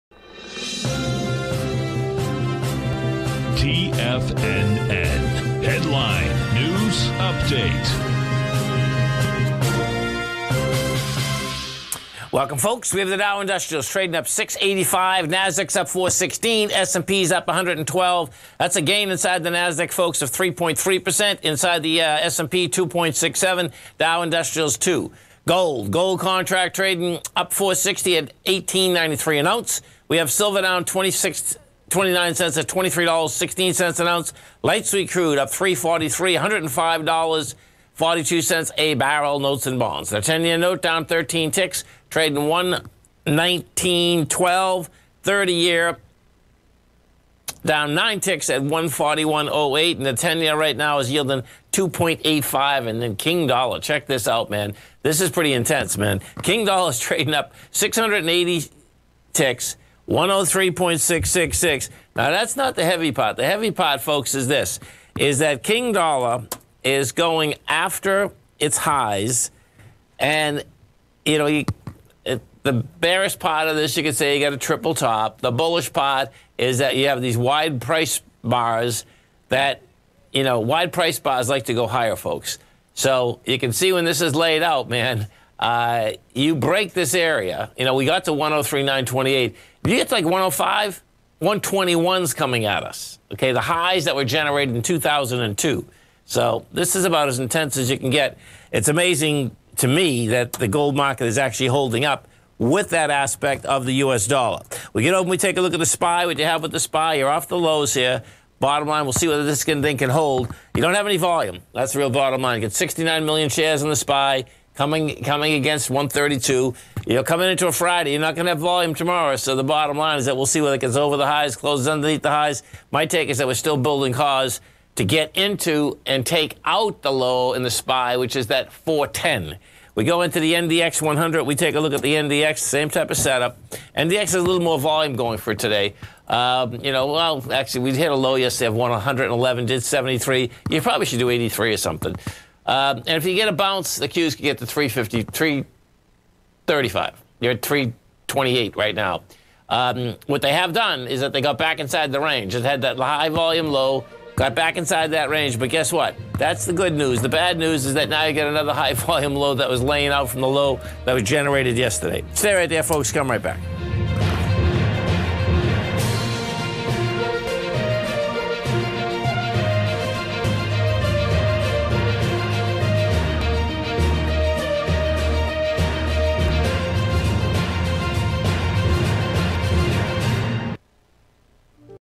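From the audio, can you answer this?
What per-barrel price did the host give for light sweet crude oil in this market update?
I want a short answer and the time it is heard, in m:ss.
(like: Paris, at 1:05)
$105.42, at 0:36.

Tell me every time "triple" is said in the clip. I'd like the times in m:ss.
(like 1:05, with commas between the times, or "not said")
1:14.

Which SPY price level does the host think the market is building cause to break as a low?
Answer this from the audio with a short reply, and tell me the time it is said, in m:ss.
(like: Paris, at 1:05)
410, at 2:08.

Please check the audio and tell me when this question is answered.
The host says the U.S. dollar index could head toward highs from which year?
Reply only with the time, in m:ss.
1:34.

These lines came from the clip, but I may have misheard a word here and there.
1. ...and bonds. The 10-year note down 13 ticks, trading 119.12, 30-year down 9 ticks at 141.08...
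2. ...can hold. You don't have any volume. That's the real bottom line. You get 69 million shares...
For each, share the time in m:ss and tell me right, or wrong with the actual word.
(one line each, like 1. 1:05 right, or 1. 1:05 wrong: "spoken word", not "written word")
1. 0:39 right
2. 1:49 right.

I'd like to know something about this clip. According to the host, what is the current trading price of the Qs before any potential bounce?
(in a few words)
328.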